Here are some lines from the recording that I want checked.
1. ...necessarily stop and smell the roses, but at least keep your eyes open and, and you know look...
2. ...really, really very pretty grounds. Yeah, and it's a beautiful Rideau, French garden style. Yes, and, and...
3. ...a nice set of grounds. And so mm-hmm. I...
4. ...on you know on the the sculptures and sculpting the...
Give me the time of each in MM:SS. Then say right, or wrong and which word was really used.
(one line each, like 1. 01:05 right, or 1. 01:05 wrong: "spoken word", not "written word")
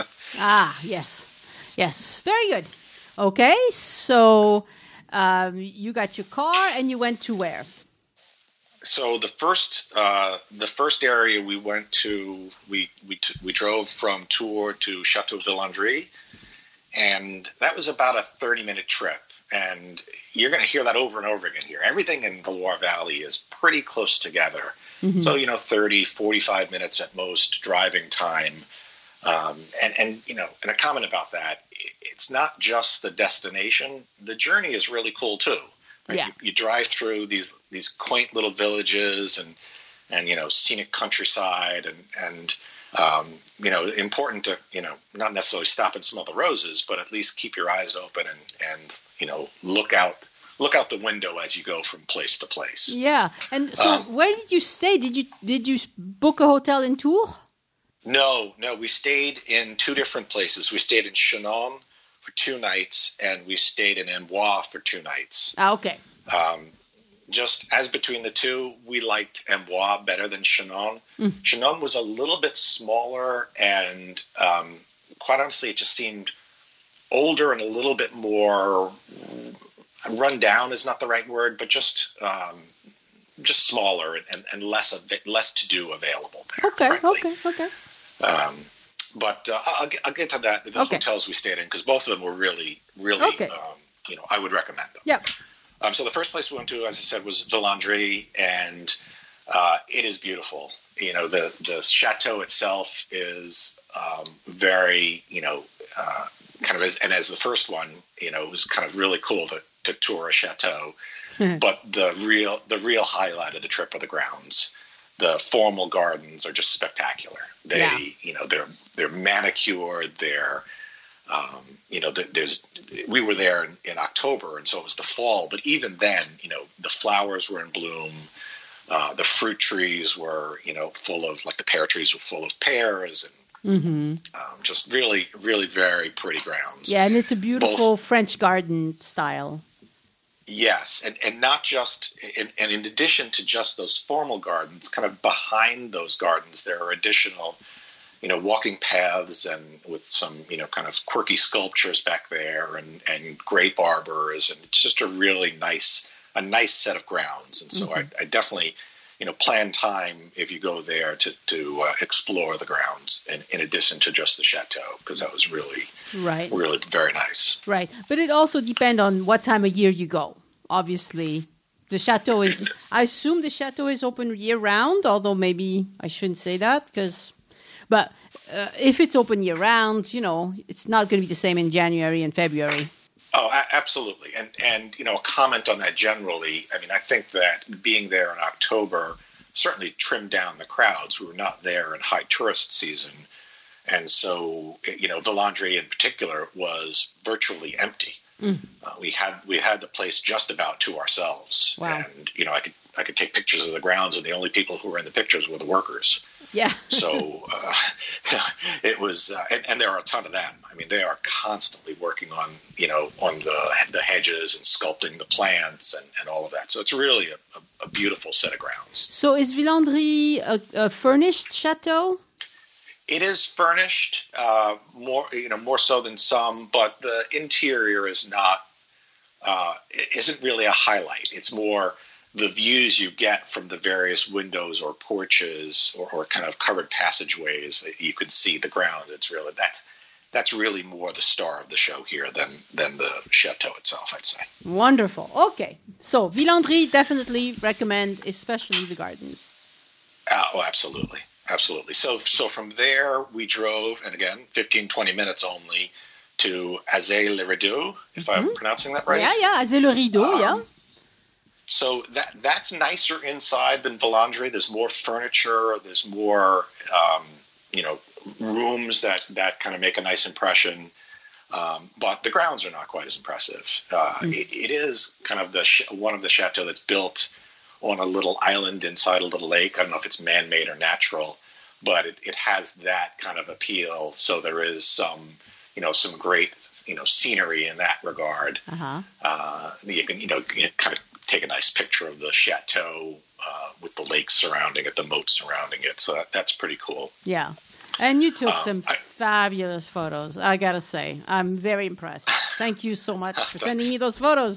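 1. 00:45 right
2. 02:14 wrong: "Both", not "Rideau"
3. 02:36 right
4. 03:32 wrong: "hedges", not "sculptures".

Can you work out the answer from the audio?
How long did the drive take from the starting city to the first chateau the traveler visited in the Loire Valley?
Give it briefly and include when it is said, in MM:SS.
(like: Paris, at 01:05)
30 minutes, at 00:17.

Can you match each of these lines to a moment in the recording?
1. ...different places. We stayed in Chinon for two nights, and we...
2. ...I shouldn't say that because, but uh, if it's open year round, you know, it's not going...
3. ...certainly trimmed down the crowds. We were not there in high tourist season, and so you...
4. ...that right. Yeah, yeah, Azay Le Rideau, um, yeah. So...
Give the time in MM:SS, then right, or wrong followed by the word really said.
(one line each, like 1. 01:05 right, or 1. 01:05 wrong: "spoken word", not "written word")
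1. 00:59 right
2. 02:56 right
3. 03:09 right
4. 04:18 right.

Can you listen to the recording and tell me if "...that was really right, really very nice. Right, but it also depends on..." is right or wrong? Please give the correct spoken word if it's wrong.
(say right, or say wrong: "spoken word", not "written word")
right.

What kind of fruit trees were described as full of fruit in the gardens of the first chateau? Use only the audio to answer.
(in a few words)
Pear trees.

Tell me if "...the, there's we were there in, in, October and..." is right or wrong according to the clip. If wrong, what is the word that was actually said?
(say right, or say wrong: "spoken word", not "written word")
right.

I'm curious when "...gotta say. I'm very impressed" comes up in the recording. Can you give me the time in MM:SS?
05:00.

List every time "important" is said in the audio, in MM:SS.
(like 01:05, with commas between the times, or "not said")
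00:43.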